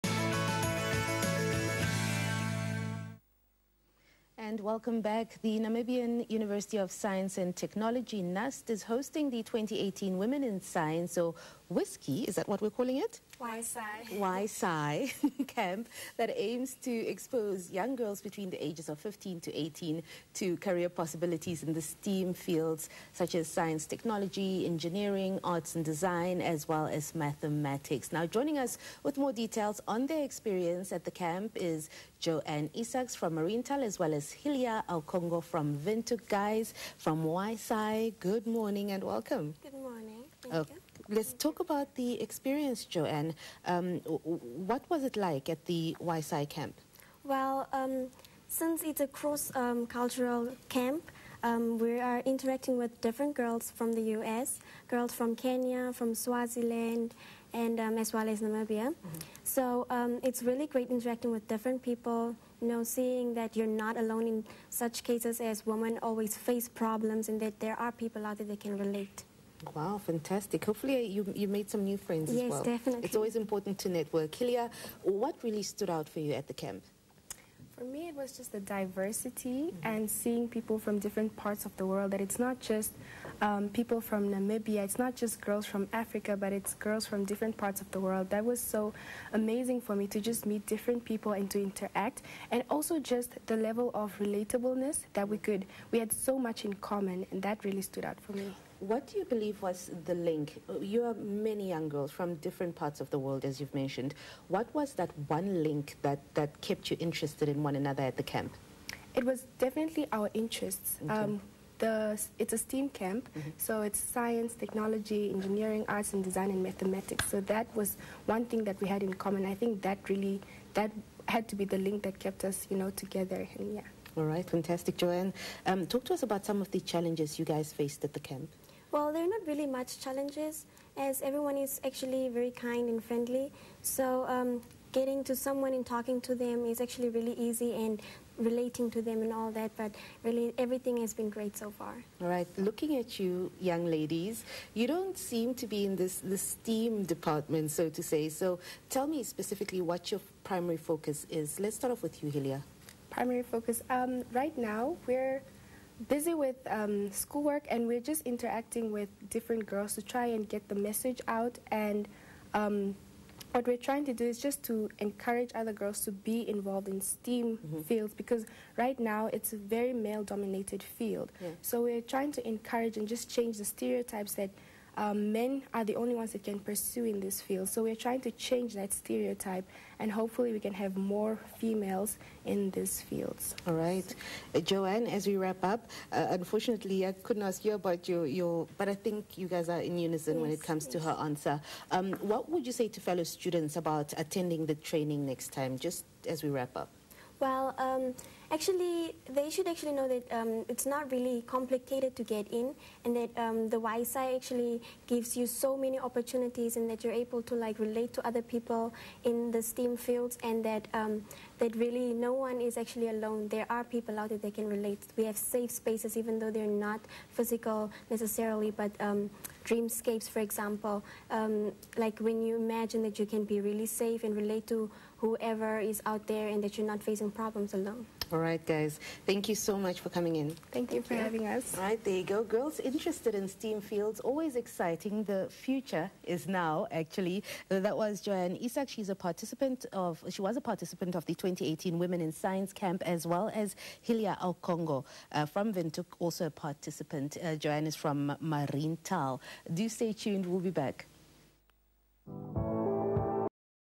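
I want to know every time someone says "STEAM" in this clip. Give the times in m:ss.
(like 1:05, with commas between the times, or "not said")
0:21, 1:52, 2:26, 2:47, 3:29, 3:53.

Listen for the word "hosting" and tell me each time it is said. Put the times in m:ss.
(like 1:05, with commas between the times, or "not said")
0:08.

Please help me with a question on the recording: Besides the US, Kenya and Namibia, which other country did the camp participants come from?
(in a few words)
Swaziland.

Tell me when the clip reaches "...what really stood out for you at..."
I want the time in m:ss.
1:15.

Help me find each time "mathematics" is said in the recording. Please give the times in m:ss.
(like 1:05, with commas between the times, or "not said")
0:27, 1:56.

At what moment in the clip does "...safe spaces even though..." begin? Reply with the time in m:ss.
3:35.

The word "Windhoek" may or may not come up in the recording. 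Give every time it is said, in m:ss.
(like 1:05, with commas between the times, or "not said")
0:35, 4:05.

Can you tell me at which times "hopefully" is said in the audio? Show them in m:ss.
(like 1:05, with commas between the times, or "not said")
1:10, 3:00.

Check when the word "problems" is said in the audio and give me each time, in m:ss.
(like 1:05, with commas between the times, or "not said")
1:06, 3:47.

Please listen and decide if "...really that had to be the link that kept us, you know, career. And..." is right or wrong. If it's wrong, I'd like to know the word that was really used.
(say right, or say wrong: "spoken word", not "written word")
wrong: "together", not "career".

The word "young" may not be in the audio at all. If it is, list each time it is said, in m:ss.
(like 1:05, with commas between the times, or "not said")
0:17, 1:41, 2:23.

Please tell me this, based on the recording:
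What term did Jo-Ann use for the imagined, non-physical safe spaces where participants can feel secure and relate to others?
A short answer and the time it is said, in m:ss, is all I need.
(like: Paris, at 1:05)
dreamscapes, at 3:39.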